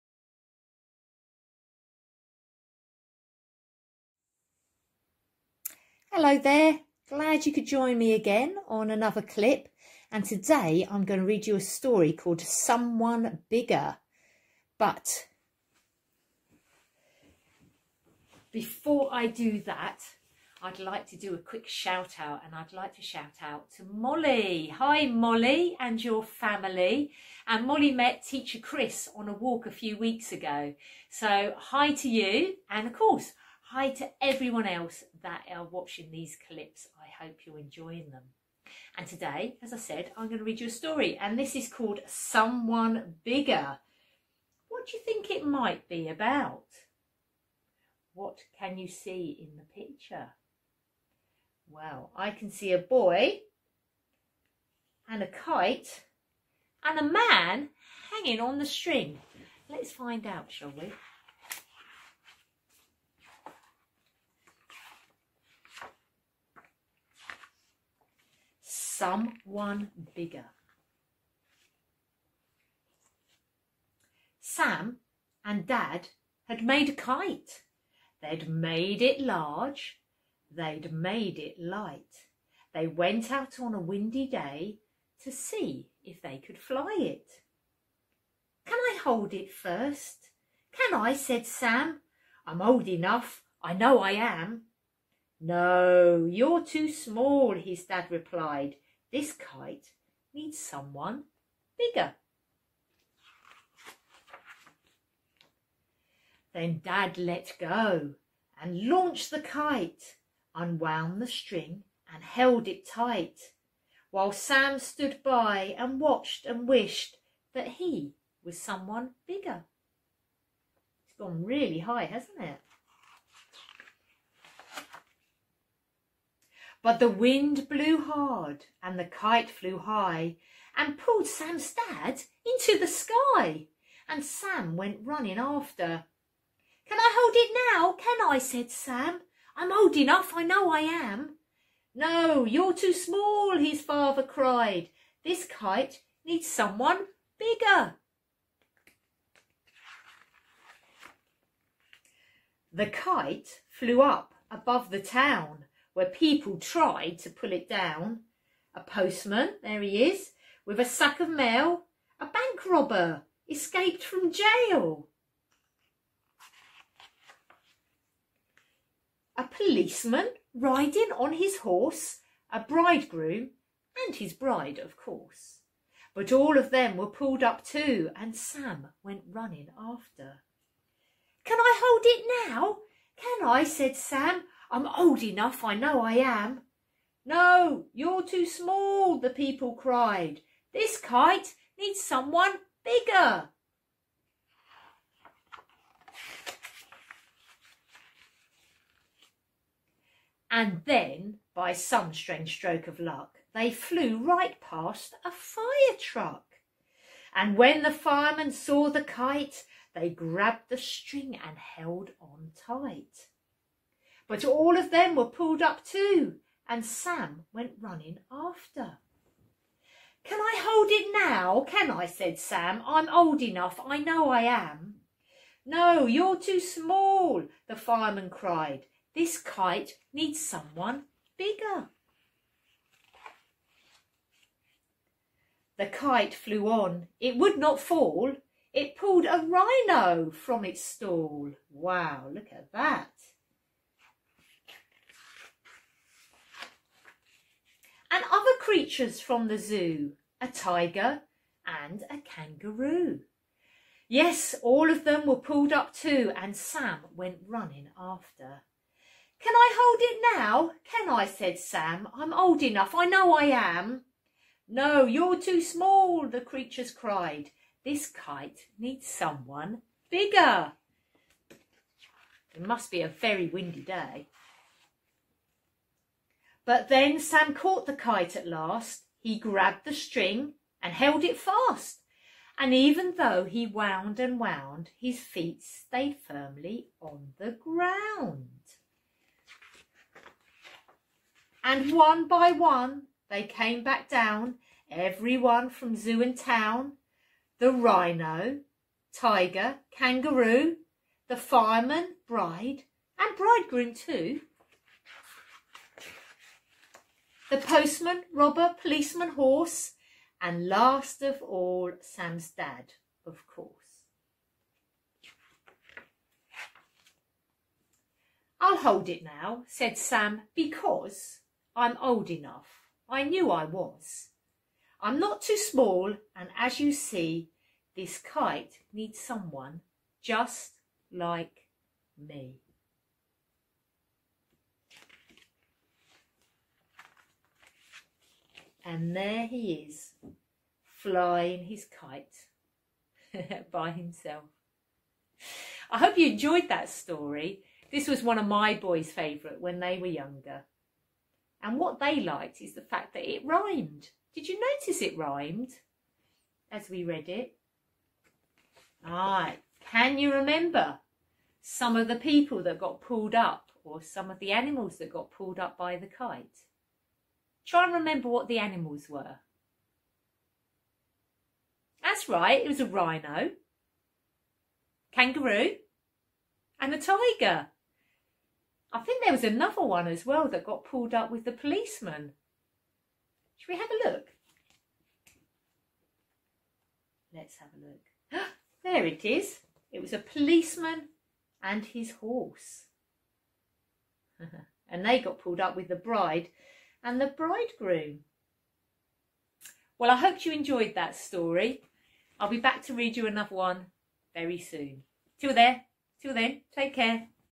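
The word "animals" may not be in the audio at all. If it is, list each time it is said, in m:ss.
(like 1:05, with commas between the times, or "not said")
6:04, 6:08.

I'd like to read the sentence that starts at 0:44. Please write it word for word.
What do you think it might be about?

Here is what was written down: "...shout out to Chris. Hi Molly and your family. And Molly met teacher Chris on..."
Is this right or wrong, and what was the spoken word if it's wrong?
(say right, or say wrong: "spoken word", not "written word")
wrong: "Molly", not "Chris".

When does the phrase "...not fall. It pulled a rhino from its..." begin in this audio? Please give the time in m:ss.
3:57.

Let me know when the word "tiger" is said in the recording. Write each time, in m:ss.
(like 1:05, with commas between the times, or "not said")
4:10, 4:59, 6:16.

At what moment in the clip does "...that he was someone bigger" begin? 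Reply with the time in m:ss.
1:57.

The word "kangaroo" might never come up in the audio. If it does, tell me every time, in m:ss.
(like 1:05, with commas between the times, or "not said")
4:12, 4:59, 6:15.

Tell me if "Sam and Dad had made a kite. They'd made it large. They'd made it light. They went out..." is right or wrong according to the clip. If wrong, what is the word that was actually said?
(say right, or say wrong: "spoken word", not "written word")
right.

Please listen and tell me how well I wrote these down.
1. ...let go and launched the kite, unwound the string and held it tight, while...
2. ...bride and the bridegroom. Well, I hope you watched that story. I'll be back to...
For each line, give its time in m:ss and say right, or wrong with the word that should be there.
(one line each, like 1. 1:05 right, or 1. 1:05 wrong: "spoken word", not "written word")
1. 1:47 right
2. 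6:35 wrong: "enjoyed", not "watched".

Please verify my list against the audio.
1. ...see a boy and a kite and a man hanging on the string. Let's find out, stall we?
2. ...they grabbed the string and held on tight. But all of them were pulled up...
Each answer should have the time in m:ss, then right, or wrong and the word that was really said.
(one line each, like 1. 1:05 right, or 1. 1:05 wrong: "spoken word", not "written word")
1. 0:52 wrong: "shall", not "stall"
2. 3:29 right.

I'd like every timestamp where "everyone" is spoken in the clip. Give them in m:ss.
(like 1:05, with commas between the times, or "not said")
0:34, 4:54.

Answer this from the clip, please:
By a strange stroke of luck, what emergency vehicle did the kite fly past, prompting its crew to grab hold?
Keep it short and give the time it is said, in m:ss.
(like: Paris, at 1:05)
fire truck, at 3:25.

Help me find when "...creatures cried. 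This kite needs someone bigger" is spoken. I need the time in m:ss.
4:26.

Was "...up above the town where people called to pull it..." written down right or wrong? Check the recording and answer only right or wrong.
wrong.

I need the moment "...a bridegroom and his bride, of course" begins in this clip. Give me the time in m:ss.
2:52.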